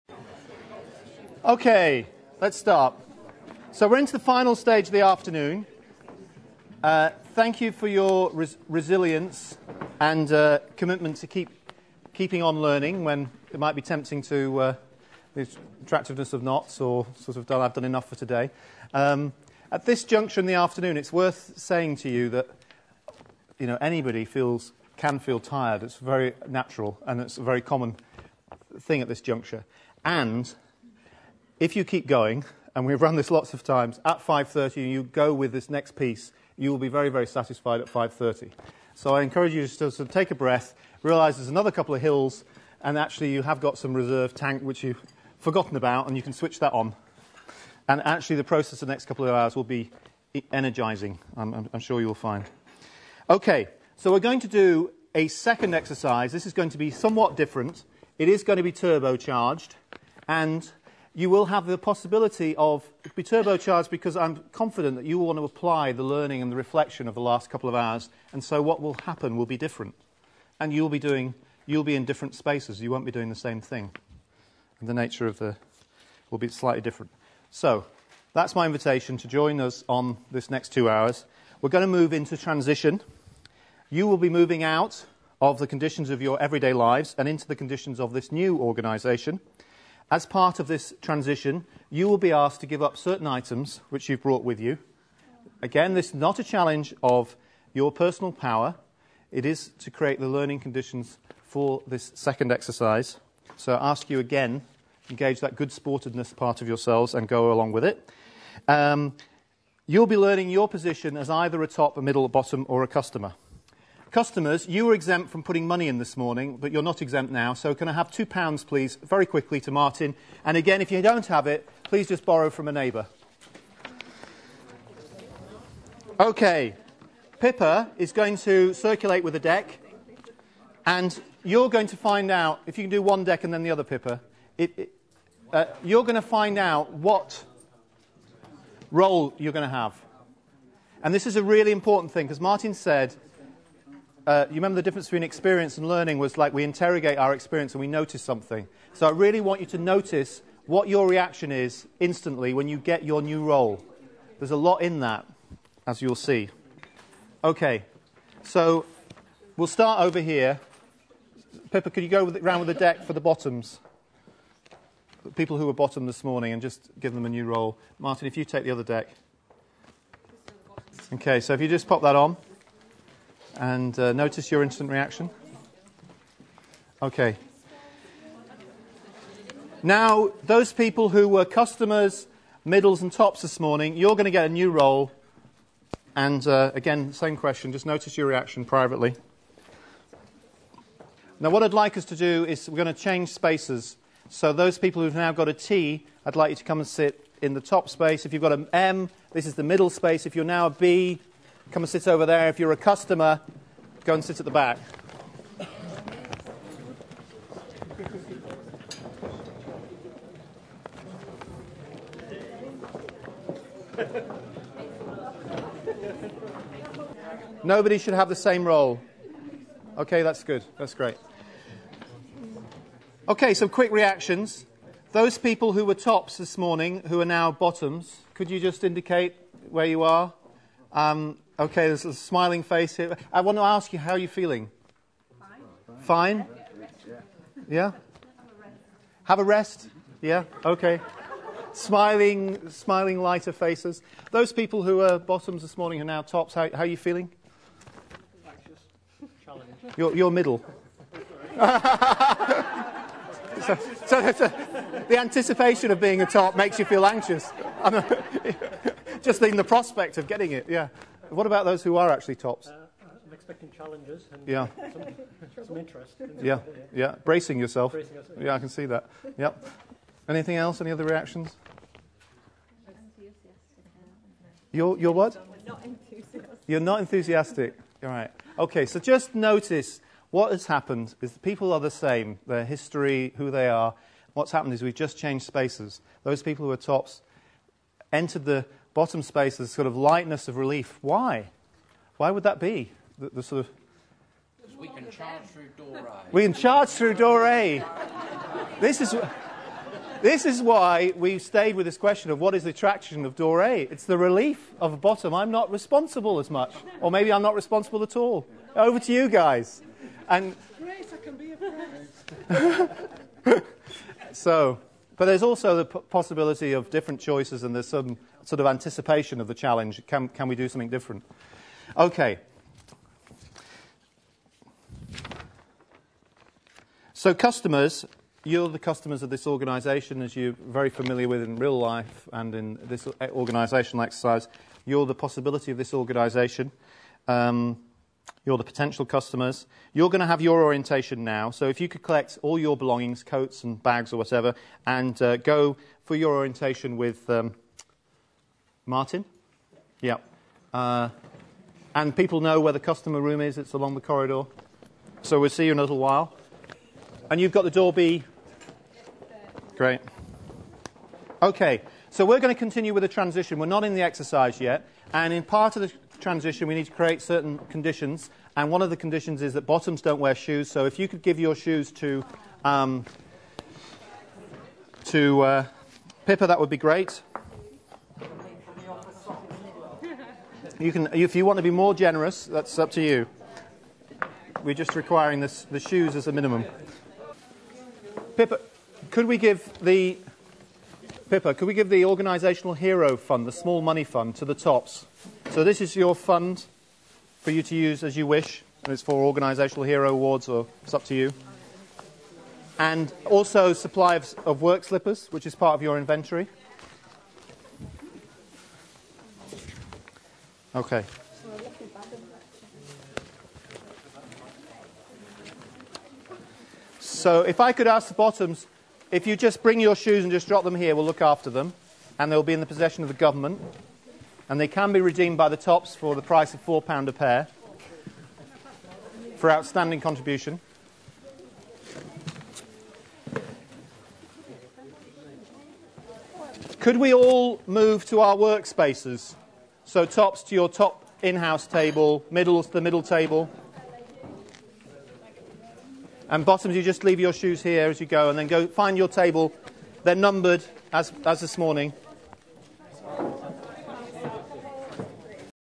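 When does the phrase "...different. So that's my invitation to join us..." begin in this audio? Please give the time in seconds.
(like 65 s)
76 s.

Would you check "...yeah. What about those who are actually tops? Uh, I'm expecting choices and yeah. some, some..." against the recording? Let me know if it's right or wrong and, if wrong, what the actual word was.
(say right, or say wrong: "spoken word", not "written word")
wrong: "challenges", not "choices".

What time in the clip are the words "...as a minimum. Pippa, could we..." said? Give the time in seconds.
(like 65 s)
386 s.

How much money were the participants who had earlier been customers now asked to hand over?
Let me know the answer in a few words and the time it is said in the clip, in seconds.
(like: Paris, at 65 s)
£2, at 118 s.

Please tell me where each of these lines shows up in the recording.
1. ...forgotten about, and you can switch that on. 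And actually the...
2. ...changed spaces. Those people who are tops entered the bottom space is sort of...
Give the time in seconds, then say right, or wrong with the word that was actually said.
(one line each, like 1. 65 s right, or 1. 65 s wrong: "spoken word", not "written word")
1. 45 s right
2. 285 s right.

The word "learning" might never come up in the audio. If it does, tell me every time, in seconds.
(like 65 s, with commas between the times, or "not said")
12 s, 66 s, 100 s, 110 s, 145 s.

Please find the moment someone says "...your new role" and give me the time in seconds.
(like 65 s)
153 s.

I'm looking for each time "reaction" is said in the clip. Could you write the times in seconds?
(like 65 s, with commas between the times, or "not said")
151 s, 174 s, 188 s, 223 s, 271 s.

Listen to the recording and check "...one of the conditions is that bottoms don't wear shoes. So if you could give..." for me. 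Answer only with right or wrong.
right.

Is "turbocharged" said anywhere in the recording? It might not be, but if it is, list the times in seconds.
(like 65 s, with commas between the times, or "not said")
58 s, 63 s.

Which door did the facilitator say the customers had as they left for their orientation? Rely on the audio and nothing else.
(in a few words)
Door B.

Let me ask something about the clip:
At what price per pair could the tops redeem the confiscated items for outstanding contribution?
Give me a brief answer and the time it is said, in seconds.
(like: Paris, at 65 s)
£4, at 426 s.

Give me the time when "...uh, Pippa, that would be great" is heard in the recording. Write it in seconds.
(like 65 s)
375 s.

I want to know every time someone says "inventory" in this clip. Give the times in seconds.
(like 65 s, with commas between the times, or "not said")
405 s.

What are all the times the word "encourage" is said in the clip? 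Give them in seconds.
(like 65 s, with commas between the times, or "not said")
39 s.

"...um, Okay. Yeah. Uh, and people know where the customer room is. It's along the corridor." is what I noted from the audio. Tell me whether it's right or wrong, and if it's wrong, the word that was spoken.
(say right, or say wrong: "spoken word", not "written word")
wrong: "Martin", not "Okay".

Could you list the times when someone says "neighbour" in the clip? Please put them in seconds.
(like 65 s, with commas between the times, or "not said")
122 s.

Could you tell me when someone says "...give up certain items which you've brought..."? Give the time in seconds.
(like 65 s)
92 s.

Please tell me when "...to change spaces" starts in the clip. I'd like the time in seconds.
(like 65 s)
192 s.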